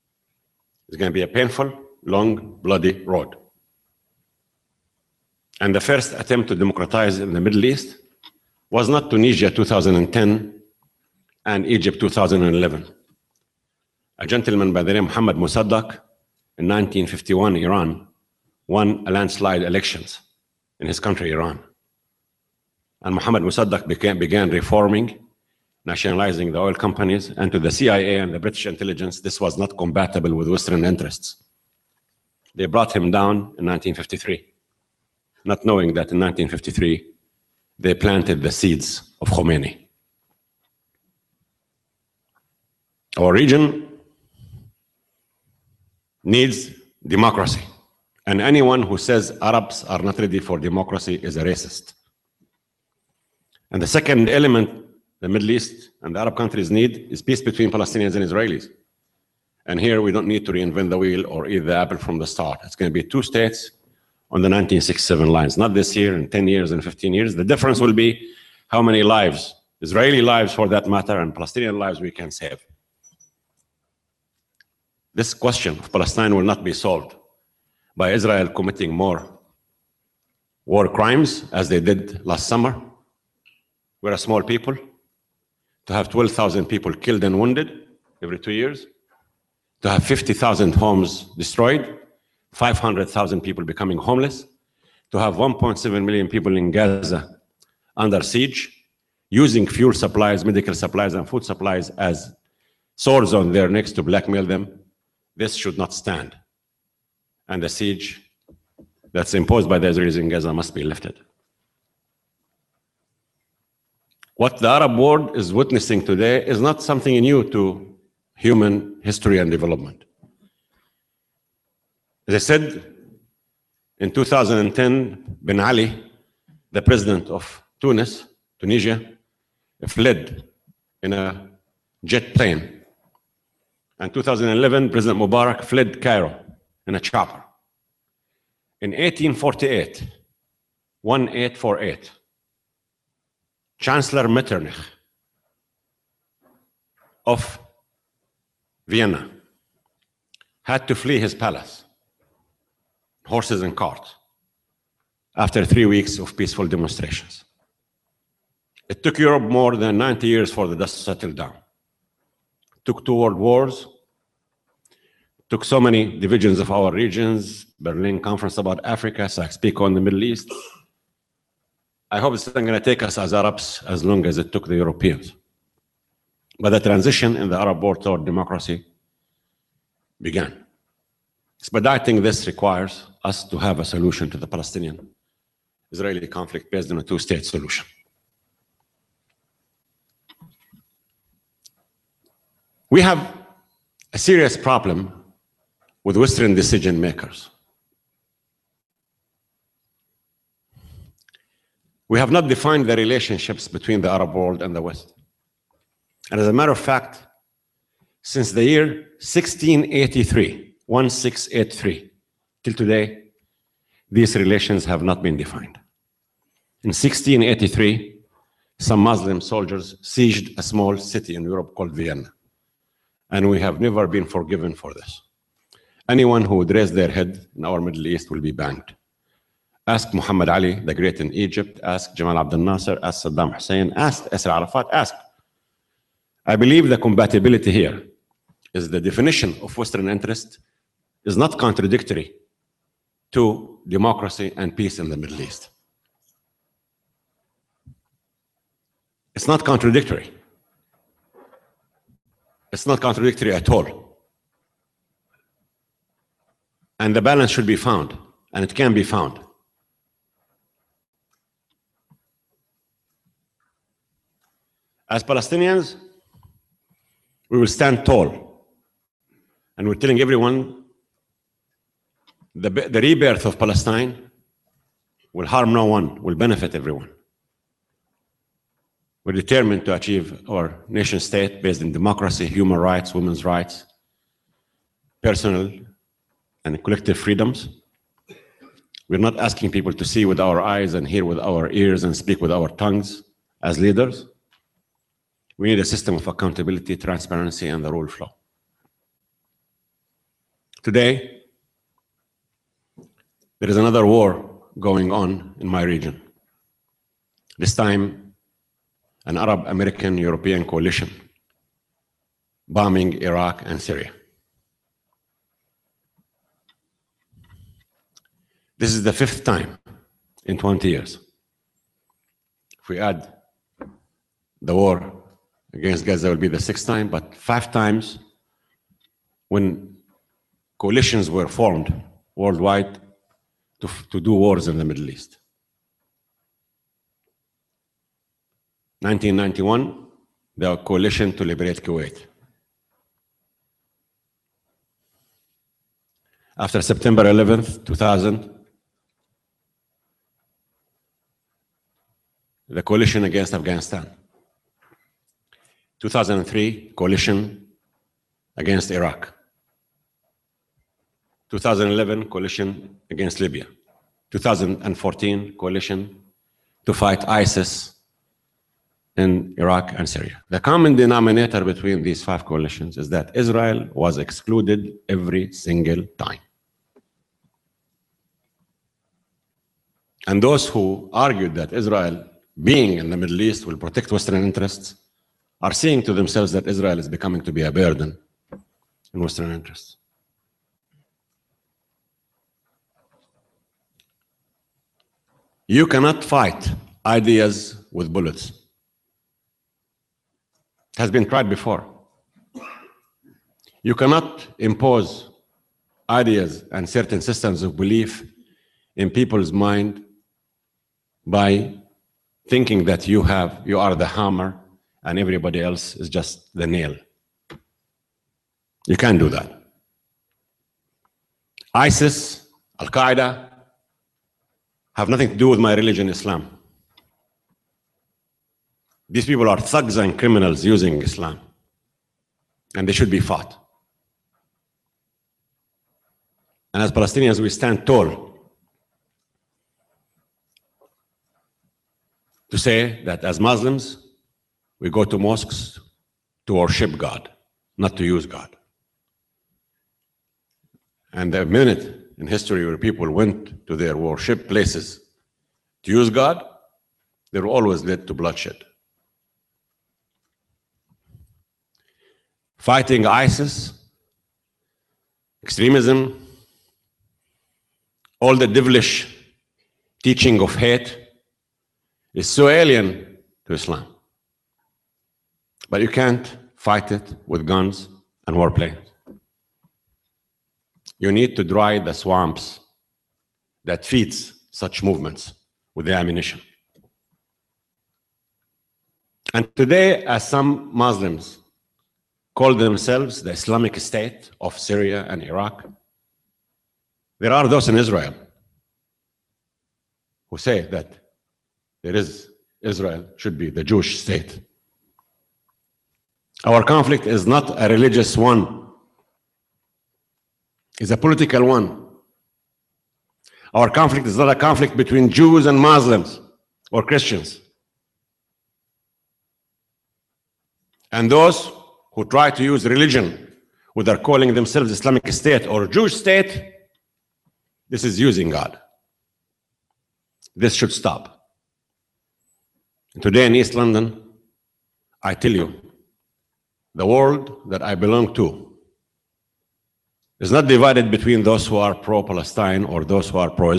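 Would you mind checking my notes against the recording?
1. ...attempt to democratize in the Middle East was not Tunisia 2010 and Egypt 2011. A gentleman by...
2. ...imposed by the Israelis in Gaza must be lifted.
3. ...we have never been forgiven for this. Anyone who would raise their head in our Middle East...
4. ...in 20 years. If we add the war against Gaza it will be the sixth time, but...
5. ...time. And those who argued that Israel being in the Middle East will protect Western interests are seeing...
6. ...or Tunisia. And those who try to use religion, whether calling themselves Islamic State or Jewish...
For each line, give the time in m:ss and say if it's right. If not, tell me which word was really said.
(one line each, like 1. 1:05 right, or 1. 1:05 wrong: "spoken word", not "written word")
1. 0:06 right
2. 1:49 right
3. 3:43 right
4. 5:20 right
5. 6:16 right
6. 8:36 wrong: "Christians", not "Tunisia".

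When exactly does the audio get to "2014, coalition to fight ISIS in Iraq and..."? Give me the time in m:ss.
6:04.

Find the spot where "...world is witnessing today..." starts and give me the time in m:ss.
1:54.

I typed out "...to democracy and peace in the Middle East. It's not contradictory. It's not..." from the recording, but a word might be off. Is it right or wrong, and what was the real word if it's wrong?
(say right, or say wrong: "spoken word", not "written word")
right.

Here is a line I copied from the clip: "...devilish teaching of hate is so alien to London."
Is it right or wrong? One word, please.
wrong.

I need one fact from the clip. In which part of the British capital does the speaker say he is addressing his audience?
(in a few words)
East London.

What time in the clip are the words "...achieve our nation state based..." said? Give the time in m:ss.
4:39.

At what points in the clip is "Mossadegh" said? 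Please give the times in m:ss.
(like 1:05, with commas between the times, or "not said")
0:15, 0:23.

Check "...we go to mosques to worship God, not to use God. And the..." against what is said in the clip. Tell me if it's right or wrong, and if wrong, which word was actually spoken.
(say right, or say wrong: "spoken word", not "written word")
right.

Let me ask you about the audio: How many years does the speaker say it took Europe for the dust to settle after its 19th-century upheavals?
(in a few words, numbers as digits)
more than 90 years.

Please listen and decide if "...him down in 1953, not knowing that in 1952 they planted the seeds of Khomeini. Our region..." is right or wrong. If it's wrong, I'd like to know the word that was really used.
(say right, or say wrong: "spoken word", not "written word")
wrong: "1953", not "1952".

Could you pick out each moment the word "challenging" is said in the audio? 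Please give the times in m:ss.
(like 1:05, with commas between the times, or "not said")
not said.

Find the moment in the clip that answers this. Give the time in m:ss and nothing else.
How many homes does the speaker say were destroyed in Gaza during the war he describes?
1:30.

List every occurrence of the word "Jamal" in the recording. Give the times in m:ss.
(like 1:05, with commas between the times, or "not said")
3:52.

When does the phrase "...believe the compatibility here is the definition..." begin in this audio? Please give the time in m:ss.
3:56.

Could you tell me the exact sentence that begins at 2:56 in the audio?
But the transition in the Arab world toward democracy began.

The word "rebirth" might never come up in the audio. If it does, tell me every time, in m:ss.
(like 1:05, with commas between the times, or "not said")
4:32.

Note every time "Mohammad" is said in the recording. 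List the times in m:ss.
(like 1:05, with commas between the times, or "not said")
0:15, 0:23.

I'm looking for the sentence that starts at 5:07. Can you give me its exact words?
This time, an Arab American European coalition bombing Iraq and Syria.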